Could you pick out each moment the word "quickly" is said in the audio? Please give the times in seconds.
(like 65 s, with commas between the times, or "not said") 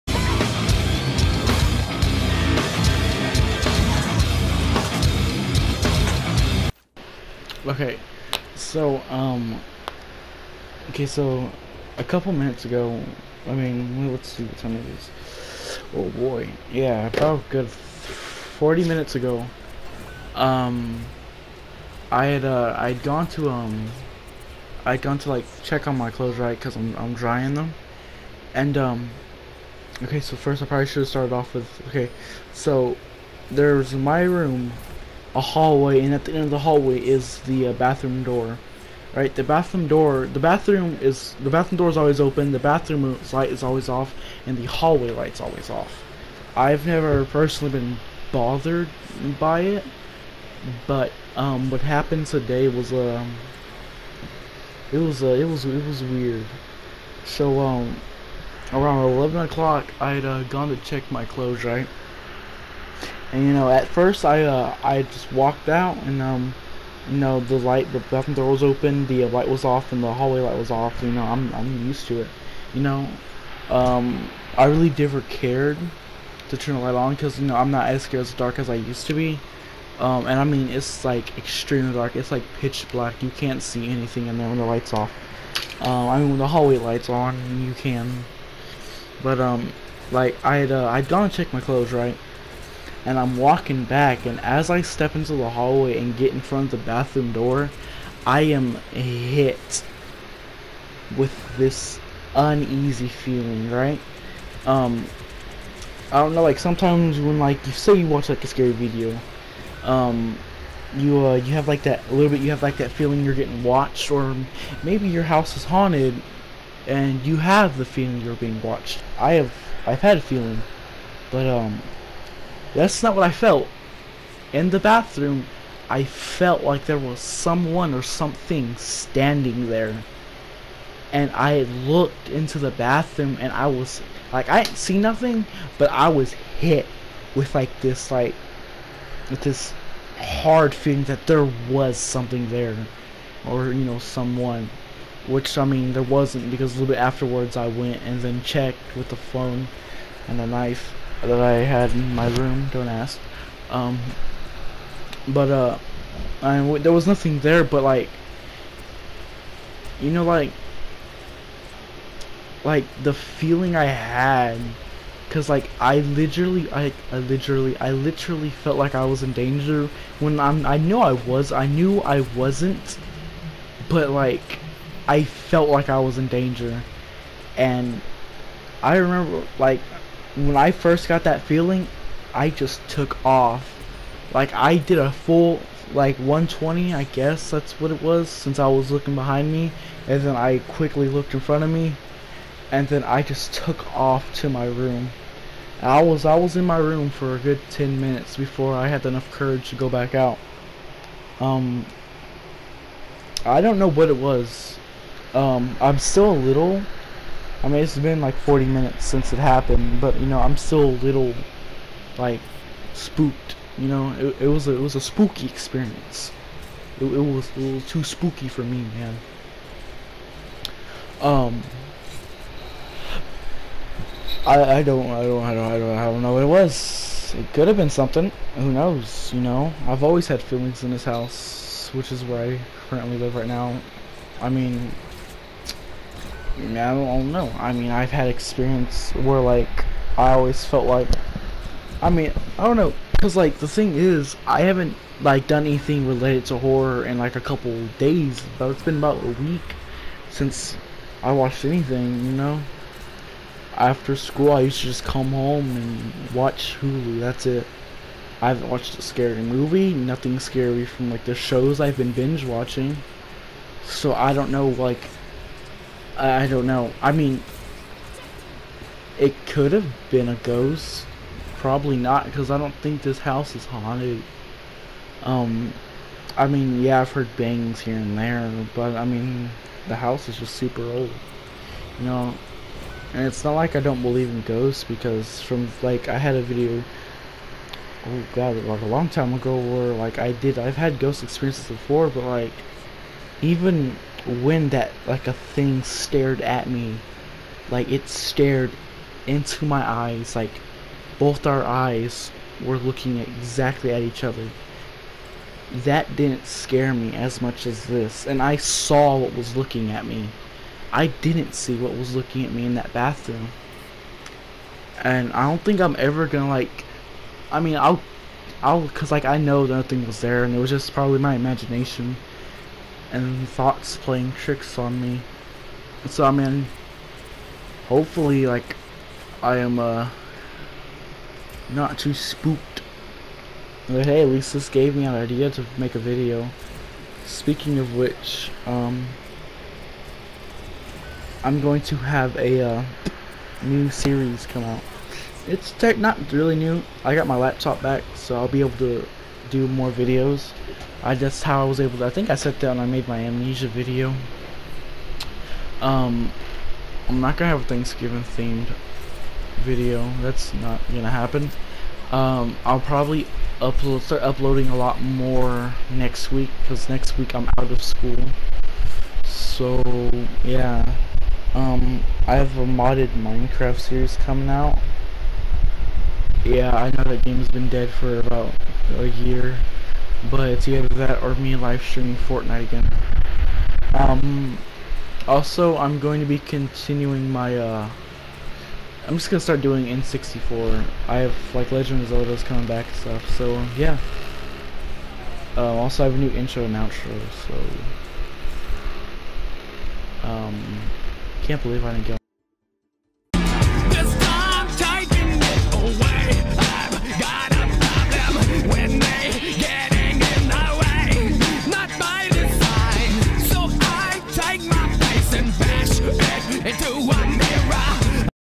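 190 s.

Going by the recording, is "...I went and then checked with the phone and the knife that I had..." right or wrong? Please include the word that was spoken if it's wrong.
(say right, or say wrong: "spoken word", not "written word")
right.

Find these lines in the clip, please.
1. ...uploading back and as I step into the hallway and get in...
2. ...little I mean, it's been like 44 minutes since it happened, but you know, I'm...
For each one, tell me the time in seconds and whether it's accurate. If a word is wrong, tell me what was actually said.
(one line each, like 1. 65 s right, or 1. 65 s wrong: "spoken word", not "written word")
1. 93 s wrong: "walking", not "uploading"
2. 206 s wrong: "40", not "44".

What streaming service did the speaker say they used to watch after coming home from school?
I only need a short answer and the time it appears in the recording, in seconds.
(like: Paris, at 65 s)
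Hulu, at 256 s.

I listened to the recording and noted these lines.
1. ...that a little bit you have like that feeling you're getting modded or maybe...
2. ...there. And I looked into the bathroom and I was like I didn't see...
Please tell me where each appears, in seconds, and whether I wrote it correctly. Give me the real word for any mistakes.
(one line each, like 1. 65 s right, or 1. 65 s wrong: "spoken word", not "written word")
1. 111 s wrong: "watched", not "modded"
2. 129 s right.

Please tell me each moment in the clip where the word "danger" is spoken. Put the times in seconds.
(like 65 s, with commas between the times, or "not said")
169 s, 176 s.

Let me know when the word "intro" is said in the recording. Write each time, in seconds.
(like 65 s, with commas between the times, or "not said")
396 s.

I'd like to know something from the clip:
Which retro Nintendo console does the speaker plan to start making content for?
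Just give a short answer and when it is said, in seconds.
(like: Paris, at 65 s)
N64, at 389 s.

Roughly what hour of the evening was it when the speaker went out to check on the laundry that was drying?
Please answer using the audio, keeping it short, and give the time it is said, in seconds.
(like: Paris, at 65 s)
11 o'clock, at 59 s.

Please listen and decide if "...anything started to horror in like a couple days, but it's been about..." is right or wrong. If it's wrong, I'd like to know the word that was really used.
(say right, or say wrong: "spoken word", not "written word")
wrong: "related", not "started".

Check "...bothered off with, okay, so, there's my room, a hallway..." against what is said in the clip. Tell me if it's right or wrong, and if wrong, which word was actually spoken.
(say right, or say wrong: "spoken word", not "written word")
wrong: "started", not "bothered".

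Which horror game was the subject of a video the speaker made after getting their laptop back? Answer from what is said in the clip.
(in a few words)
Amnesia.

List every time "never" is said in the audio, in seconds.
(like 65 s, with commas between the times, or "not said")
46 s, 74 s.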